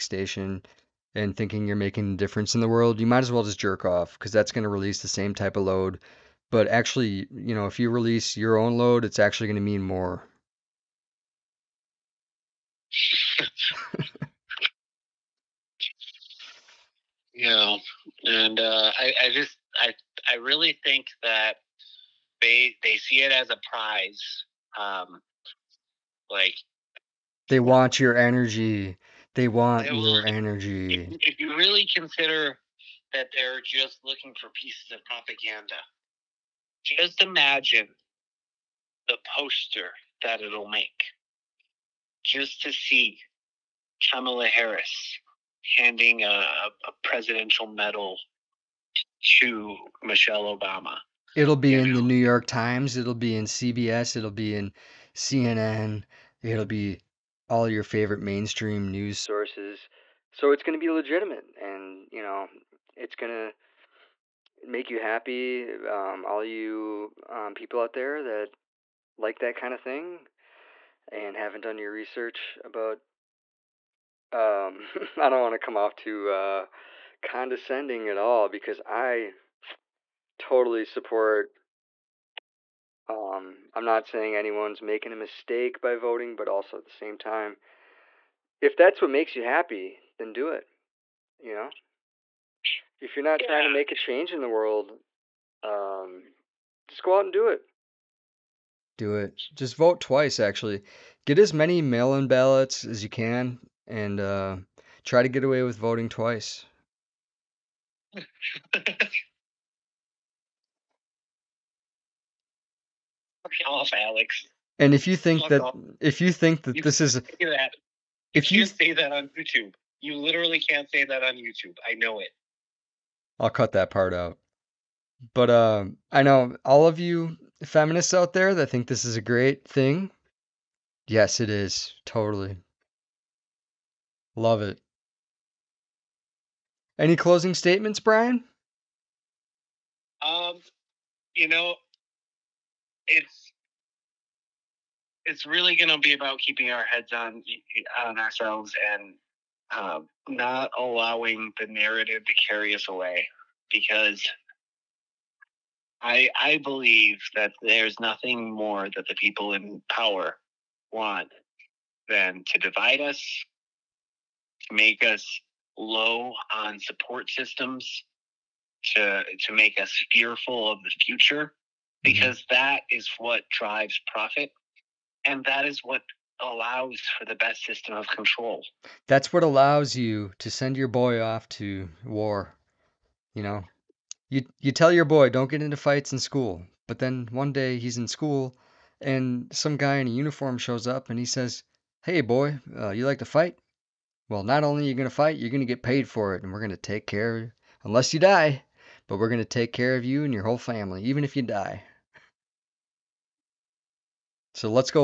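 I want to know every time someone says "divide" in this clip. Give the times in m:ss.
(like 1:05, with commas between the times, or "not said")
2:42.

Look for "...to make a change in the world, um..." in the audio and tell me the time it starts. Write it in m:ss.
1:33.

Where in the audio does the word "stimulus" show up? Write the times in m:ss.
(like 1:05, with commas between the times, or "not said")
not said.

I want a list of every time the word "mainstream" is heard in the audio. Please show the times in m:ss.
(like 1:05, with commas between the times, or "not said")
0:58.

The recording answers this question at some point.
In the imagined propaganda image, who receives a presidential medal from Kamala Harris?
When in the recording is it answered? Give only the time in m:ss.
0:50.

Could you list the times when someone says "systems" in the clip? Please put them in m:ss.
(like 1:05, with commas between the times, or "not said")
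2:47, 2:57.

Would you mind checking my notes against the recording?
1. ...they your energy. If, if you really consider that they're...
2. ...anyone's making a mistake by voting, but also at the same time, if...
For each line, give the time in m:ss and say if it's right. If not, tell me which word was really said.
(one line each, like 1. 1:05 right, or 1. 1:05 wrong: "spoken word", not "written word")
1. 0:29 right
2. 1:24 right.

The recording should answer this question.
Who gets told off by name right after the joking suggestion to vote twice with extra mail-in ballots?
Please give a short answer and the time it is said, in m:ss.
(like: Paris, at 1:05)
Alex, at 1:53.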